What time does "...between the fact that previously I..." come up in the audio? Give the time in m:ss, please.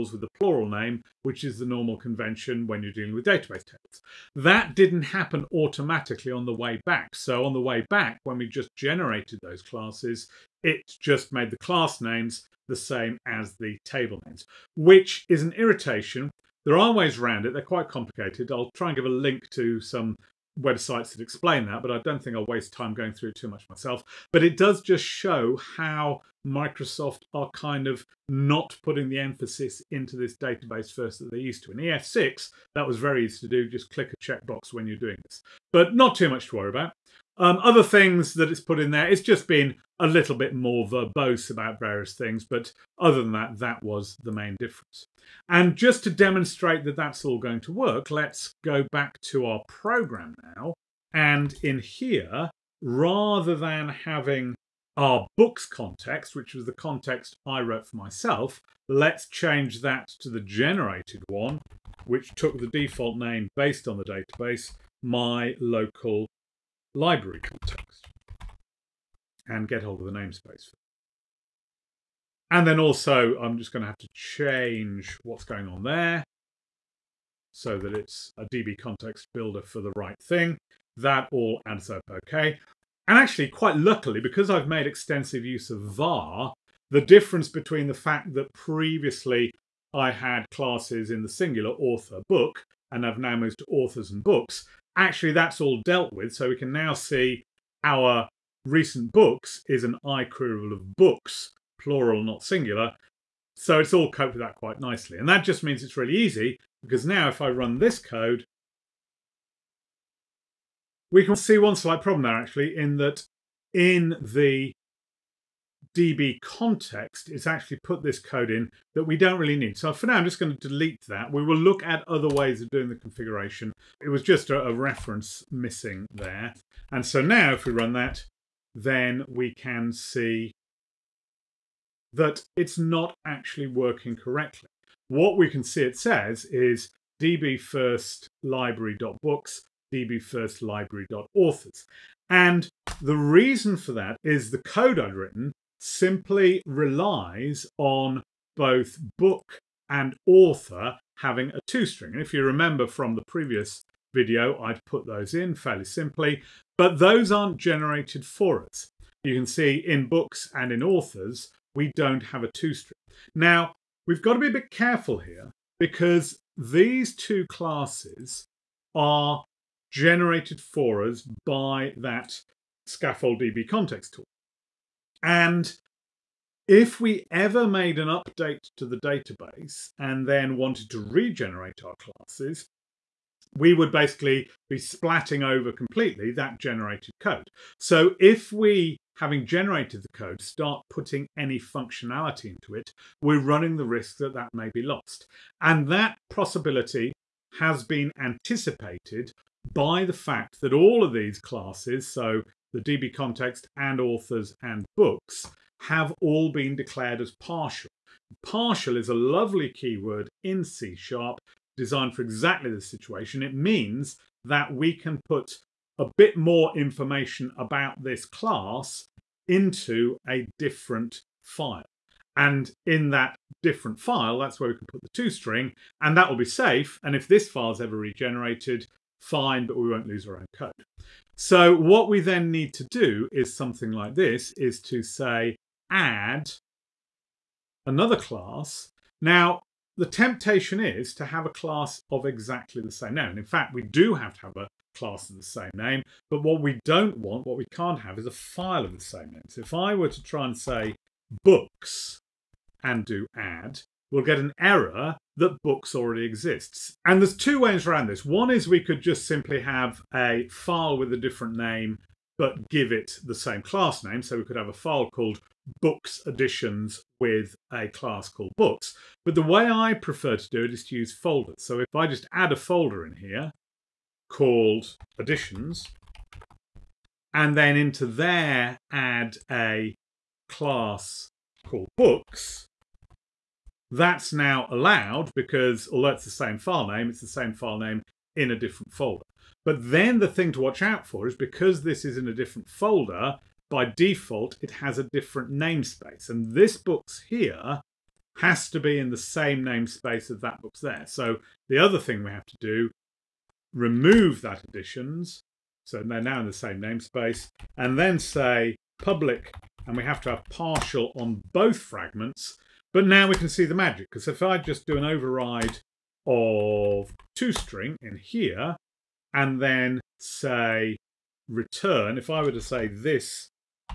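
1:27.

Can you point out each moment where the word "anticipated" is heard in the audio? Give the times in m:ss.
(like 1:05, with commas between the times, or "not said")
3:18.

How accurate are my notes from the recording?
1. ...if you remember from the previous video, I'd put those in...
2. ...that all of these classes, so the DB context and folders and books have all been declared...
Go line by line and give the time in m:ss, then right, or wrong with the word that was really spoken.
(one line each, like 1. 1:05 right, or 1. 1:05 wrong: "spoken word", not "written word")
1. 2:32 right
2. 3:20 wrong: "authors", not "folders".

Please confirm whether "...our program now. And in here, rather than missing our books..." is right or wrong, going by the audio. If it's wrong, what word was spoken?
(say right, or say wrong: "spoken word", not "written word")
wrong: "having", not "missing".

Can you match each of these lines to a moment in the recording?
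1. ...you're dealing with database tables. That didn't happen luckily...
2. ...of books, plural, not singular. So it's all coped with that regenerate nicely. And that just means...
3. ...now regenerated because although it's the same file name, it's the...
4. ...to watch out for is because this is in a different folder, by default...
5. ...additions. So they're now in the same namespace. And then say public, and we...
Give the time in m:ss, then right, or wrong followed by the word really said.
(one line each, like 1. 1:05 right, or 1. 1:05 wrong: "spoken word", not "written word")
1. 0:02 wrong: "automatically", not "luckily"
2. 1:40 wrong: "quite", not "regenerate"
3. 4:44 wrong: "allowed", not "regenerated"
4. 4:50 right
5. 5:04 right.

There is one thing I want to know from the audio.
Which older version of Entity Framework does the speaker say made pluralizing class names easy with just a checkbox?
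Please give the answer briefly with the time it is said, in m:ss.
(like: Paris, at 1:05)
EF6, at 0:31.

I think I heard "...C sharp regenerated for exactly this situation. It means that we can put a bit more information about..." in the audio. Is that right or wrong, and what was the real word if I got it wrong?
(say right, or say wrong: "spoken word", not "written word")
wrong: "designed", not "regenerated".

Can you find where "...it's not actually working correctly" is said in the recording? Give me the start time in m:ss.
2:12.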